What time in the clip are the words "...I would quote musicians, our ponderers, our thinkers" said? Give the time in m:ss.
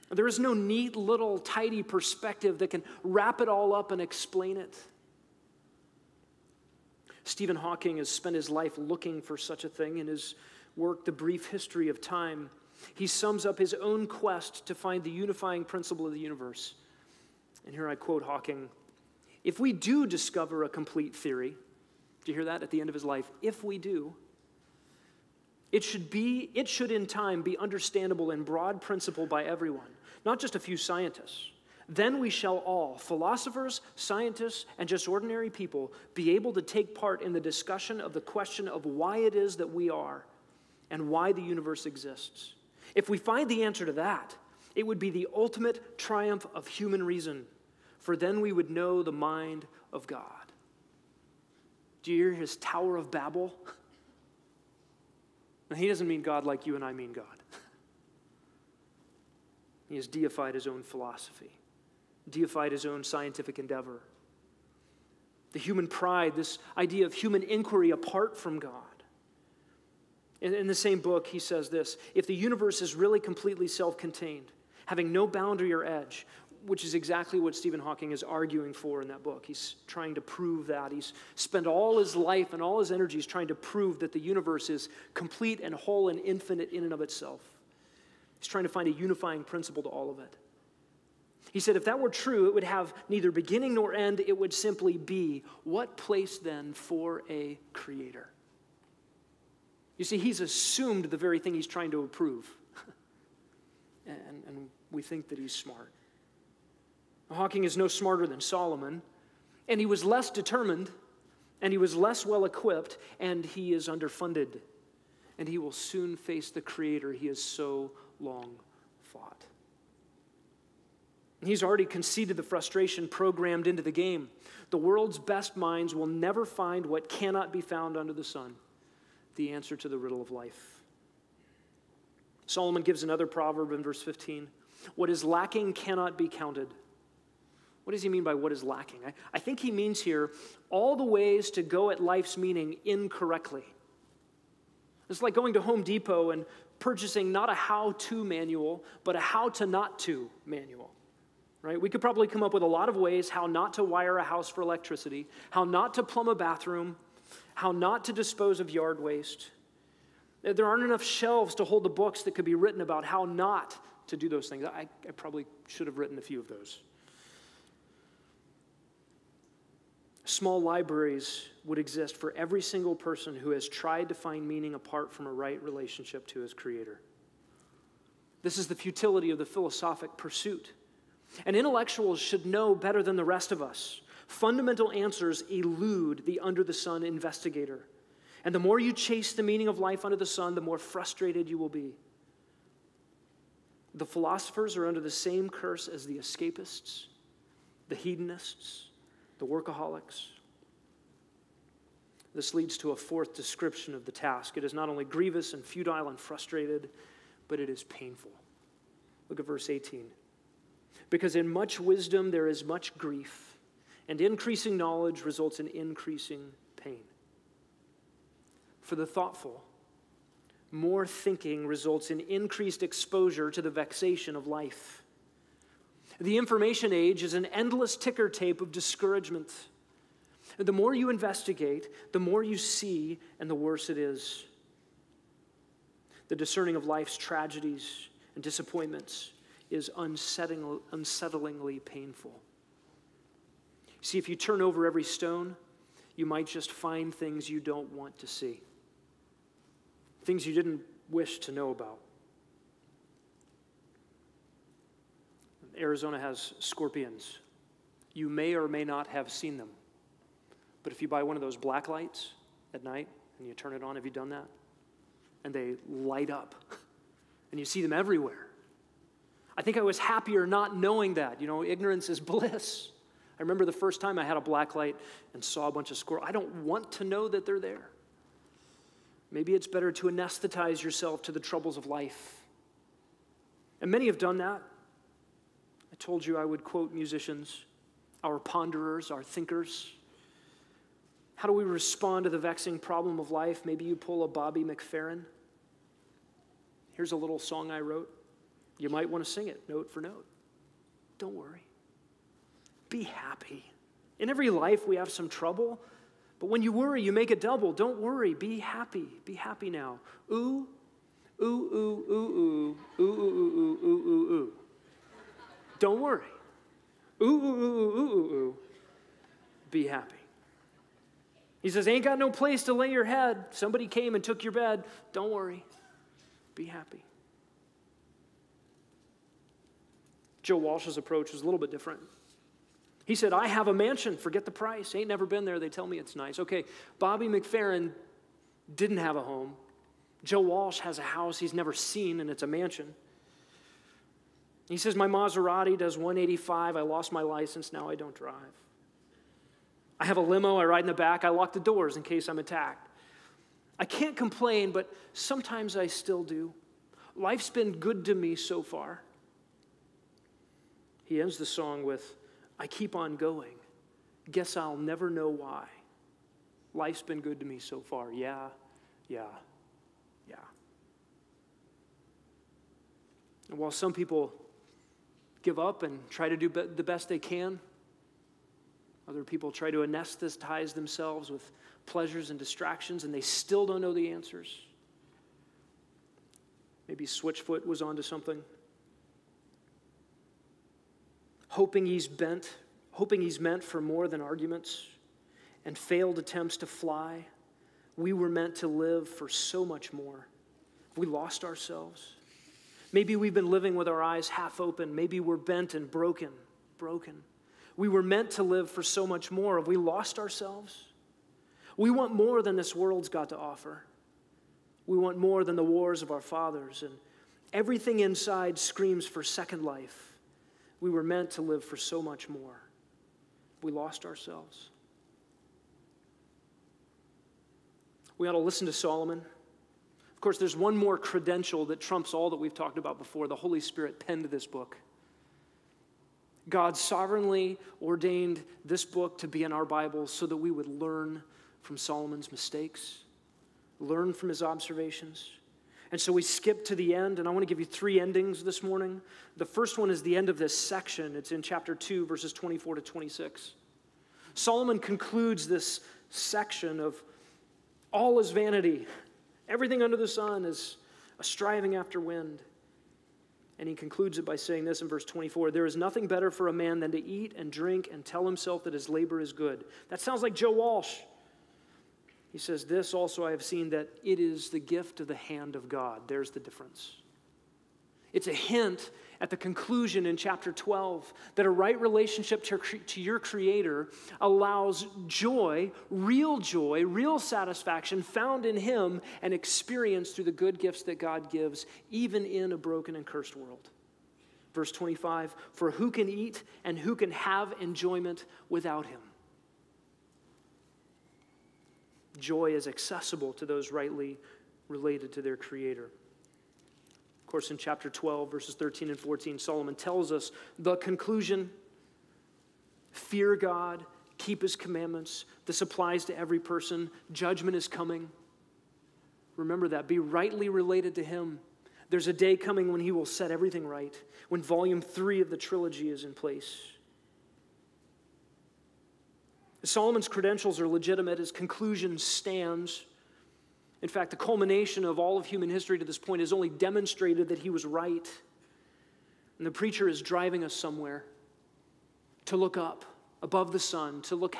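4:46.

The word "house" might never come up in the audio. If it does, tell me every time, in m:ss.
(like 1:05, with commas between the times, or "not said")
2:34, 5:41.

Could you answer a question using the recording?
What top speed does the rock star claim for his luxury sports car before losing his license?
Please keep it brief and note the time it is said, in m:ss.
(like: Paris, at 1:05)
185, at 5:45.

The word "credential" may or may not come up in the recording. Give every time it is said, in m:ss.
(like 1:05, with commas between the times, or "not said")
7:10, 8:50.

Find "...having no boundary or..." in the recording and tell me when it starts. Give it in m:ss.
1:14.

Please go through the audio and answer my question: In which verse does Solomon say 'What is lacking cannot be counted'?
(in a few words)
Verse 15.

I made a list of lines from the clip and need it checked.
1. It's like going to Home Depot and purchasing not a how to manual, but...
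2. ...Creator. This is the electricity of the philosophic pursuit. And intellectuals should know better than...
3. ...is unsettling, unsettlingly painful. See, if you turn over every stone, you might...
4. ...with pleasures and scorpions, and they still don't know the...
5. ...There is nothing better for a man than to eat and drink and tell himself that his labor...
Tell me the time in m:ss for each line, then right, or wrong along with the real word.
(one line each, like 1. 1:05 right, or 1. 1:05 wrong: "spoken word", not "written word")
1. 2:25 right
2. 2:56 wrong: "futility", not "electricity"
3. 3:59 right
4. 6:21 wrong: "distractions", not "scorpions"
5. 7:45 right.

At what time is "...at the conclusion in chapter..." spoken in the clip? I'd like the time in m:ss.
7:59.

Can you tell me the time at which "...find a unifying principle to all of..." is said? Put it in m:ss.
1:28.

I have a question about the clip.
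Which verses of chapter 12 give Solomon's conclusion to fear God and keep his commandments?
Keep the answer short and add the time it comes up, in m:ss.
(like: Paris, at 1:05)
13 and 14, at 8:28.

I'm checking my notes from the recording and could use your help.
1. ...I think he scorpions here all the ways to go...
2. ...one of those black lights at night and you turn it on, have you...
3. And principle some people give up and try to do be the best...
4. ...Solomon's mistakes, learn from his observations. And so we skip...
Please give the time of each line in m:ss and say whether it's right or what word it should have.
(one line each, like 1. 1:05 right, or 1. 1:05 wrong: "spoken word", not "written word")
1. 2:19 wrong: "means", not "scorpions"
2. 4:21 right
3. 6:13 wrong: "while", not "principle"
4. 7:21 right.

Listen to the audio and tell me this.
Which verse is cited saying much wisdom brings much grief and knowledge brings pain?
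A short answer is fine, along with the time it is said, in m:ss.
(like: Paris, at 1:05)
Verse 18, at 3:29.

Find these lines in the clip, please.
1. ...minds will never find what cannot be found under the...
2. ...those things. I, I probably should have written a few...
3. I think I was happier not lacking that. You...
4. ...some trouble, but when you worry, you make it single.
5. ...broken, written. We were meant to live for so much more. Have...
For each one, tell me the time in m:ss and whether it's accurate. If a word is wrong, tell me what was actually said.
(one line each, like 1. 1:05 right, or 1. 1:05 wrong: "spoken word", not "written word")
1. 2:05 right
2. 2:44 right
3. 4:29 wrong: "knowing", not "lacking"
4. 5:05 wrong: "double", not "single"
5. 6:45 wrong: "broken", not "written".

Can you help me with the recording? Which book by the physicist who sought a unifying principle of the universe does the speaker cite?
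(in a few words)
The Brief History of Time.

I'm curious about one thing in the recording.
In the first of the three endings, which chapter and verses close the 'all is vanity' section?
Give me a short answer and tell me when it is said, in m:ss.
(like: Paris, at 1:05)
Chapter 2, verses 24 to 26, at 7:31.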